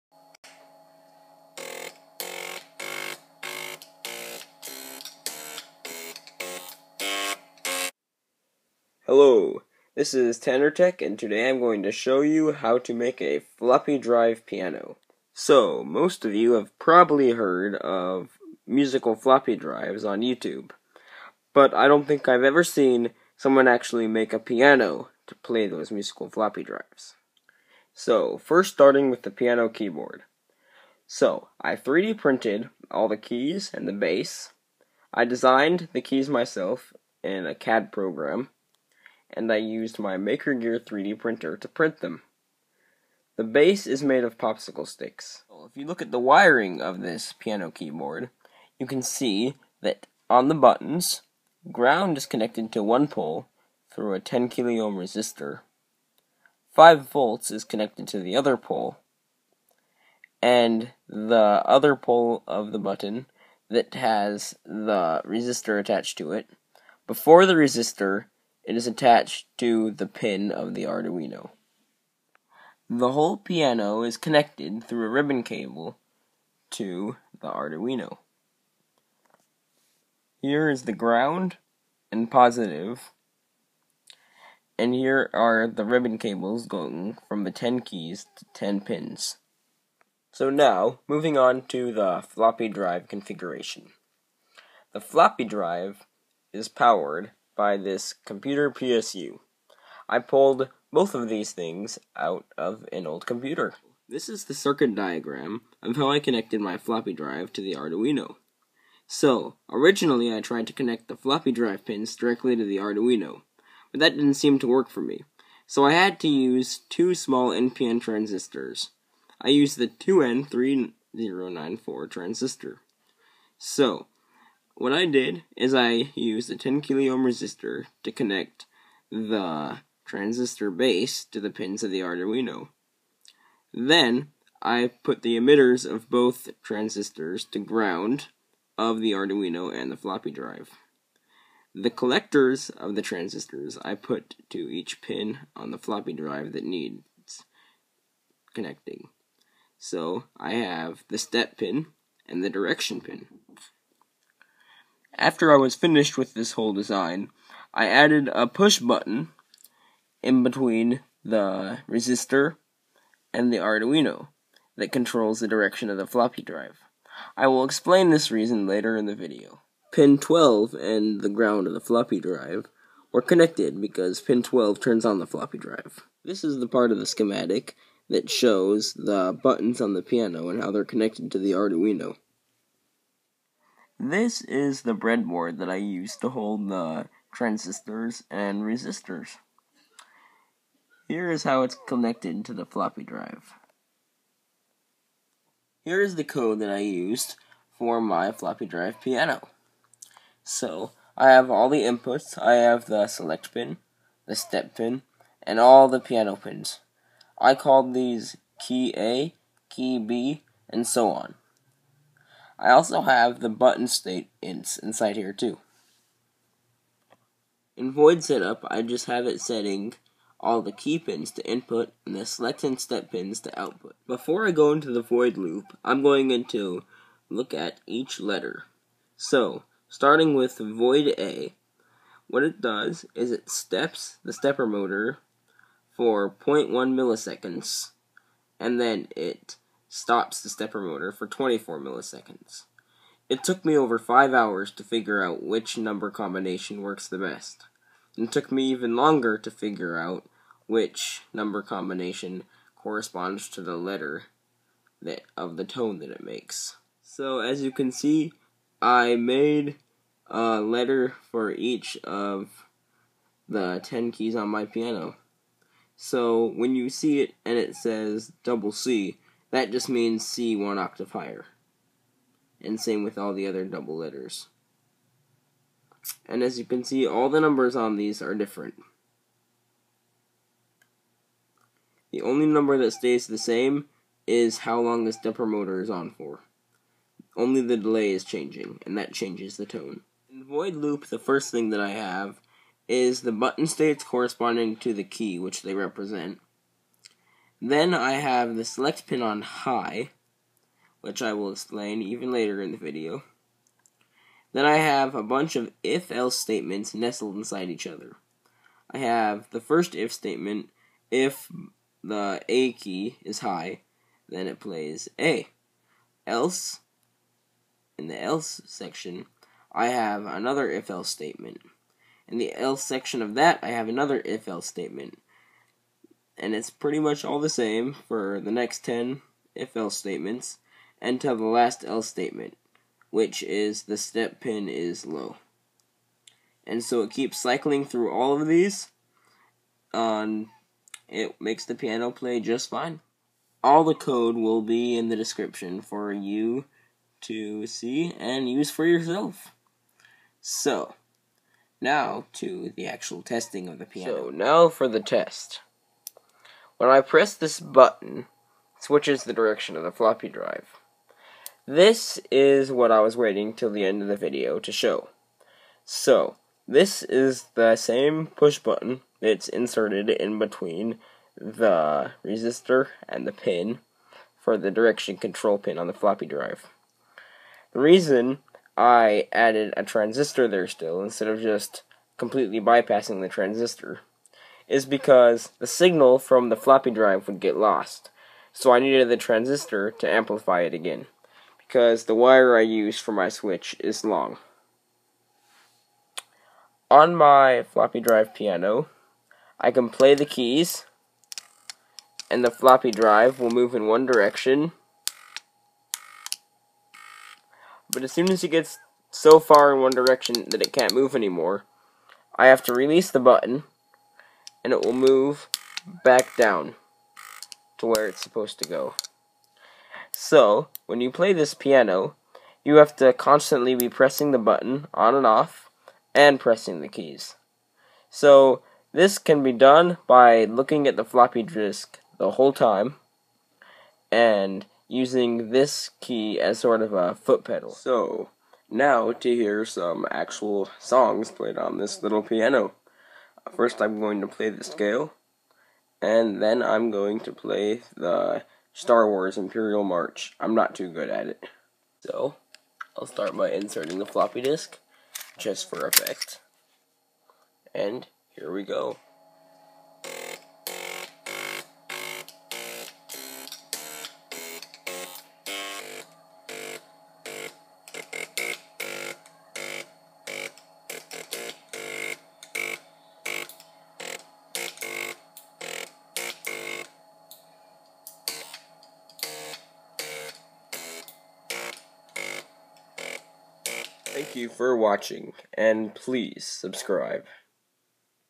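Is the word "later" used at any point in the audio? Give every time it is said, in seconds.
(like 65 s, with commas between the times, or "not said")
168 s, 302 s.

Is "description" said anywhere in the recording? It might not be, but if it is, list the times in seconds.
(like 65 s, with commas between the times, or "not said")
345 s.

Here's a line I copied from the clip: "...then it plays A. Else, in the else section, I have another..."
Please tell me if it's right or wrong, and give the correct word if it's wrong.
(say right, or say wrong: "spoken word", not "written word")
right.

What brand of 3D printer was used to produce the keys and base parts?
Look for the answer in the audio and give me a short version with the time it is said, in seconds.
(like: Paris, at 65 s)
Maker Gear, at 40 s.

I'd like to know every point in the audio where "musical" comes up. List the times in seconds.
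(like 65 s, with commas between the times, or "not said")
18 s, 25 s.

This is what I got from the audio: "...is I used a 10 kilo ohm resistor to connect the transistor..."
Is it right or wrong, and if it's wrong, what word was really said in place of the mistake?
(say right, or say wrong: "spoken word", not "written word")
right.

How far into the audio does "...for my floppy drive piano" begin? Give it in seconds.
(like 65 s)
197 s.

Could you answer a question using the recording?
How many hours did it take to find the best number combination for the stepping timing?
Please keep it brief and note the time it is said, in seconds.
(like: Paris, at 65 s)
5, at 243 s.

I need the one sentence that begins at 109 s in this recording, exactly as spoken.
So, originally I tried to connect the floppy drive pins directly to the Arduino, but that didn't seem to work for me.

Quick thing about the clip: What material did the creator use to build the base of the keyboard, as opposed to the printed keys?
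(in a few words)
Popsicle sticks.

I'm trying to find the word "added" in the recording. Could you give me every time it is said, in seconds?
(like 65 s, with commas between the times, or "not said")
157 s, 379 s.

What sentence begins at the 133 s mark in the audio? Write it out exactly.
Then I put the emitters of both transistors to ground of the Arduino and the floppy drive.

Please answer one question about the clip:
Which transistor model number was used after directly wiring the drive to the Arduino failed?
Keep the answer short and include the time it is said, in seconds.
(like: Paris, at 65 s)
2N3094, at 119 s.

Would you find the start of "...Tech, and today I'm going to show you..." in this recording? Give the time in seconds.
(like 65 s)
10 s.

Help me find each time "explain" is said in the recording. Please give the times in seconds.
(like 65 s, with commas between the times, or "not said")
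167 s, 301 s.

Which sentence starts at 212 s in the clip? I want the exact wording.
I also have the button state ins inside here too.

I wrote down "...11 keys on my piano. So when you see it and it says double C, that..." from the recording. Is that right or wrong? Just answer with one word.
wrong.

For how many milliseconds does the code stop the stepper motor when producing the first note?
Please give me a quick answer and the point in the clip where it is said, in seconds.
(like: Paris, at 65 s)
24, at 241 s.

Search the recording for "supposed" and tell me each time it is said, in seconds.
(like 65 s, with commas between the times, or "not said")
418 s.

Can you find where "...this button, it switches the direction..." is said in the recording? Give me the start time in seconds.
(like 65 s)
357 s.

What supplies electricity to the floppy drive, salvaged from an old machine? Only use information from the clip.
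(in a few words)
Computer PSU.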